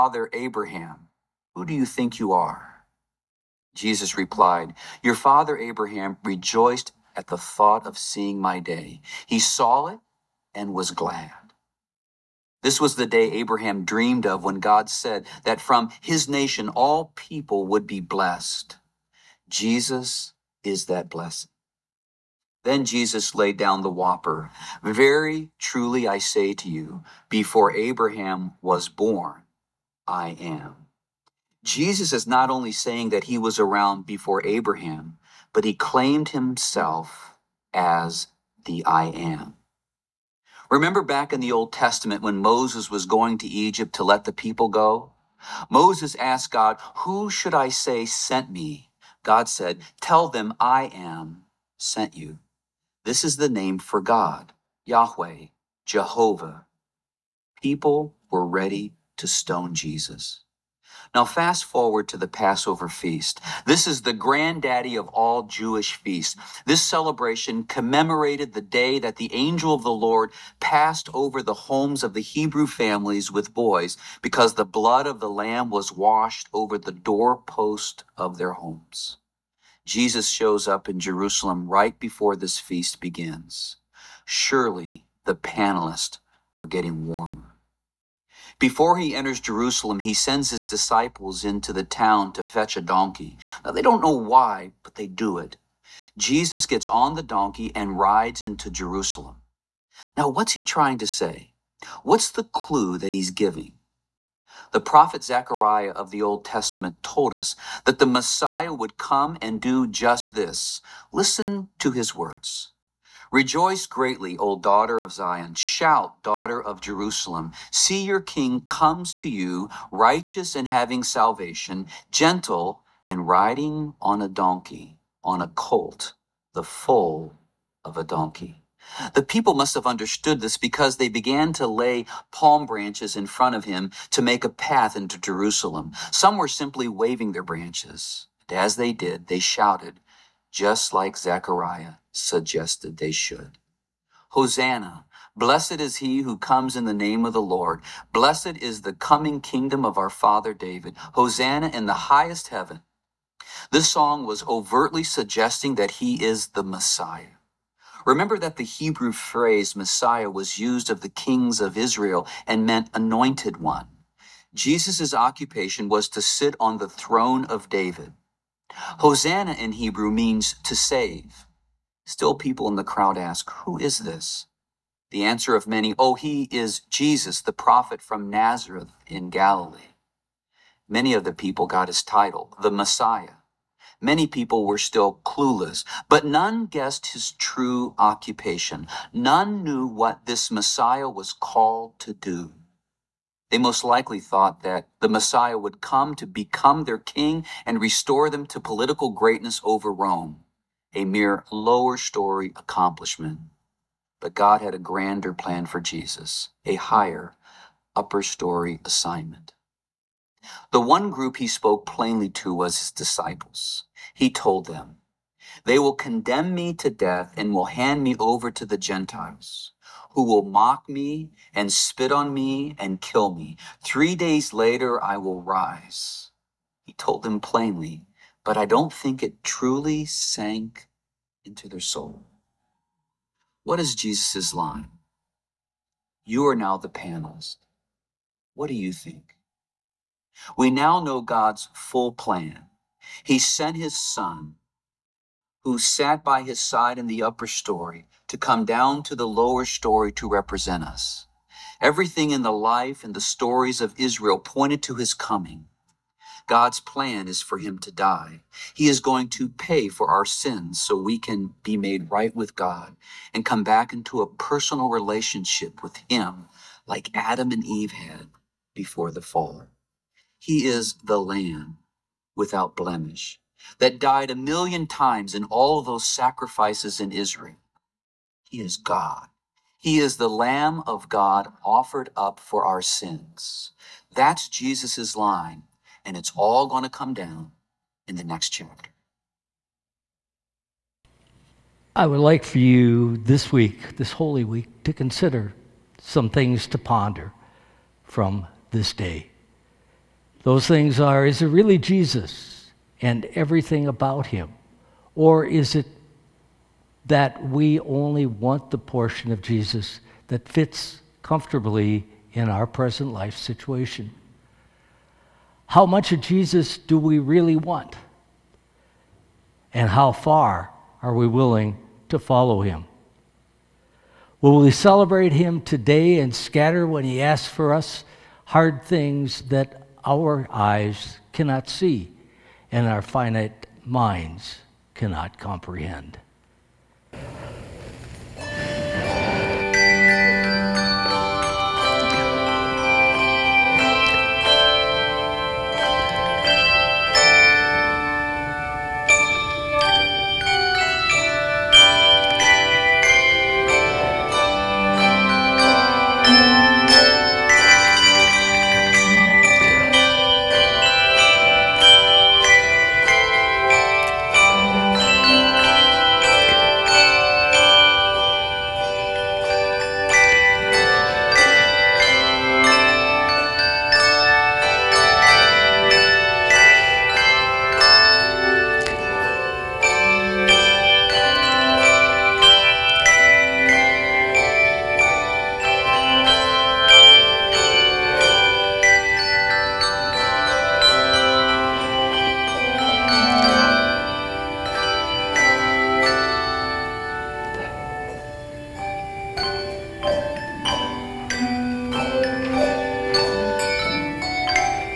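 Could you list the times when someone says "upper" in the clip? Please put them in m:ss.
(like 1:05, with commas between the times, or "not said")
3:27, 4:07.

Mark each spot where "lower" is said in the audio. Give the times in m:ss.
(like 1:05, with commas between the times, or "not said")
3:21, 4:09.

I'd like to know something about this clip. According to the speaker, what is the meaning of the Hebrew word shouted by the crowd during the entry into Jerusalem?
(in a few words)
To save.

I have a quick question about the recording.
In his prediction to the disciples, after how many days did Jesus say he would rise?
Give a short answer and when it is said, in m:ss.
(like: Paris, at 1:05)
3, at 3:43.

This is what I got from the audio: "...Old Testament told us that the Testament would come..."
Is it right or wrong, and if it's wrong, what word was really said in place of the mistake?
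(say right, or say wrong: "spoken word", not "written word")
wrong: "Messiah", not "Testament".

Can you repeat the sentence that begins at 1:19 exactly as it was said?
Jesus shows up in Jerusalem right before this feast begins.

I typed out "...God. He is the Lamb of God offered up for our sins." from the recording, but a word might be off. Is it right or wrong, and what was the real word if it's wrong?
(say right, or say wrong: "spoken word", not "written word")
right.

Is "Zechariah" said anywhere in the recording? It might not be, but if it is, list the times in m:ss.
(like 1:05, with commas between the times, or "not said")
1:45, 2:21.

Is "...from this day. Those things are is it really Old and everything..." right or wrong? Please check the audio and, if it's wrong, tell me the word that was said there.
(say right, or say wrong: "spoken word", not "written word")
wrong: "Jesus", not "Old".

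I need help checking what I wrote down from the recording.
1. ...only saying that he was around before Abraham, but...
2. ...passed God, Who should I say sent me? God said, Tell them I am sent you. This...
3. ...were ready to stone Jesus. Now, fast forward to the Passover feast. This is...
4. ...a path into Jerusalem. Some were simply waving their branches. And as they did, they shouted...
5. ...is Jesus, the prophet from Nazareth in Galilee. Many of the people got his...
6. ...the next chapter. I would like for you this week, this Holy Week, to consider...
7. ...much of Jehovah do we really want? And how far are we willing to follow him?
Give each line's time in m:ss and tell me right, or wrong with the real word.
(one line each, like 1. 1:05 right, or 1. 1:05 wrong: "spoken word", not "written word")
1. 0:32 right
2. 0:46 wrong: "asked", not "passed"
3. 0:58 right
4. 2:14 right
5. 2:56 right
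6. 4:48 right
7. 5:15 wrong: "Jesus", not "Jehovah".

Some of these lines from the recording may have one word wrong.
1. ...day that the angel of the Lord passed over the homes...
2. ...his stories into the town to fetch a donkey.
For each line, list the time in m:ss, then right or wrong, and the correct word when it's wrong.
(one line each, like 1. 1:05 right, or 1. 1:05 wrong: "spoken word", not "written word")
1. 1:08 right
2. 1:30 wrong: "disciples", not "stories".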